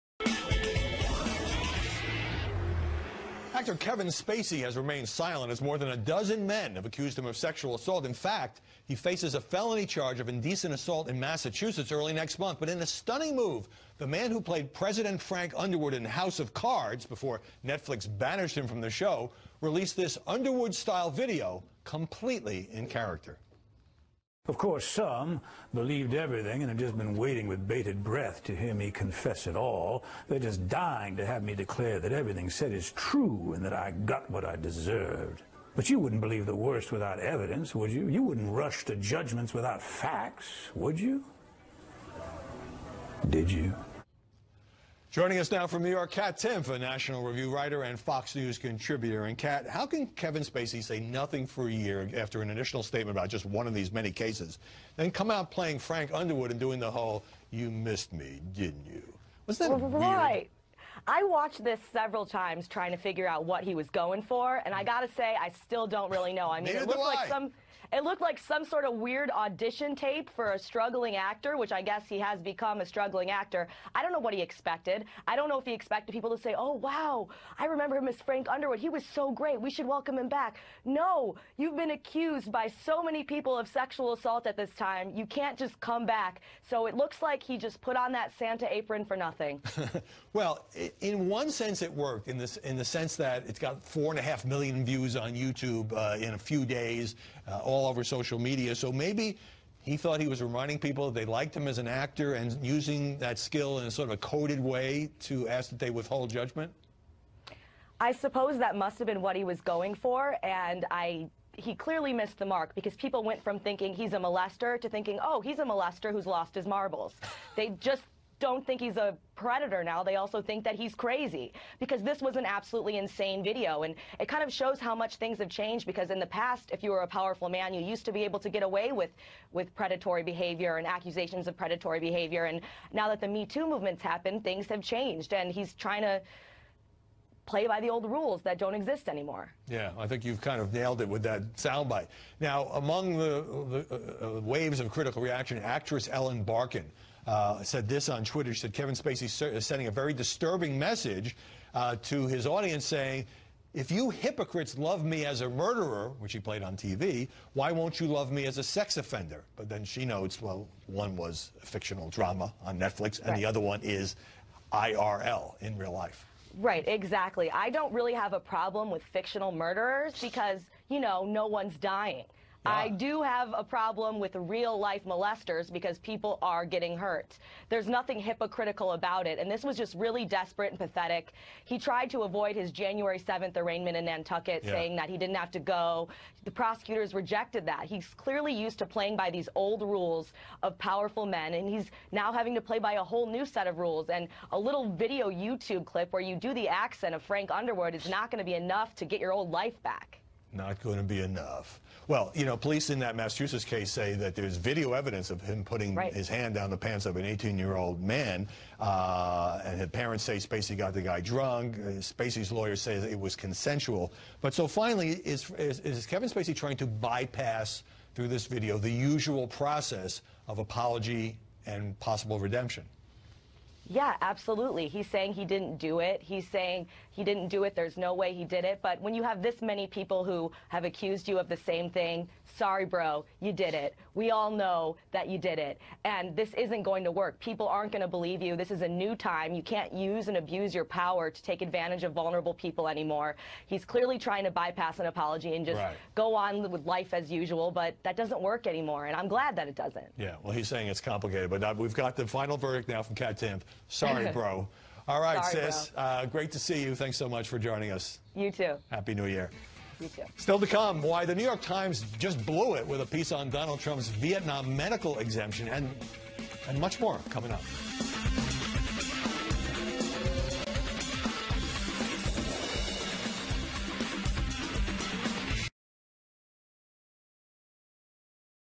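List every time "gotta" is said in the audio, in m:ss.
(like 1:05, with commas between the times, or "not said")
1:04.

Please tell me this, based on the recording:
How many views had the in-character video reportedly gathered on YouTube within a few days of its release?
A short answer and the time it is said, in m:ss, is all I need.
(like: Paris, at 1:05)
4.5 million, at 1:33.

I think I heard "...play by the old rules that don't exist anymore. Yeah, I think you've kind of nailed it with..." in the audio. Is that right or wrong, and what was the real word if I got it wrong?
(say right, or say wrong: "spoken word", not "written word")
right.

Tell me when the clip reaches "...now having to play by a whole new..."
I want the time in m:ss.
3:12.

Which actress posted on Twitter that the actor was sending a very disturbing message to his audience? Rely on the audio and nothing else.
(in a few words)
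Ellen Barkin.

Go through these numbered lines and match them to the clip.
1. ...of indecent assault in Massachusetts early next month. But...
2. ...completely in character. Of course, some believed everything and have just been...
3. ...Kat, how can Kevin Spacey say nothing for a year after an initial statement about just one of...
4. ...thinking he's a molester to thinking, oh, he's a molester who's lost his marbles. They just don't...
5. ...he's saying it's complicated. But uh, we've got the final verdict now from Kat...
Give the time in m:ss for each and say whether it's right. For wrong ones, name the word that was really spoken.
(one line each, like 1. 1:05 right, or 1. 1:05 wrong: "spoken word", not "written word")
1. 0:10 right
2. 0:21 right
3. 0:49 right
4. 1:53 right
5. 4:10 right.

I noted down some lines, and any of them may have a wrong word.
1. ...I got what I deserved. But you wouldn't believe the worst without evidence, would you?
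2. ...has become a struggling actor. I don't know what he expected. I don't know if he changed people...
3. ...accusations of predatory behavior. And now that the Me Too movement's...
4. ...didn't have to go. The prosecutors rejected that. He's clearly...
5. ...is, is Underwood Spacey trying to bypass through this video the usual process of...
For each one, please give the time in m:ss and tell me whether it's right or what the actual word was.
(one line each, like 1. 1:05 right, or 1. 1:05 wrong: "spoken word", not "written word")
1. 0:33 right
2. 1:12 wrong: "expected", not "changed"
3. 2:10 right
4. 3:05 right
5. 3:35 wrong: "Kevin", not "Underwood".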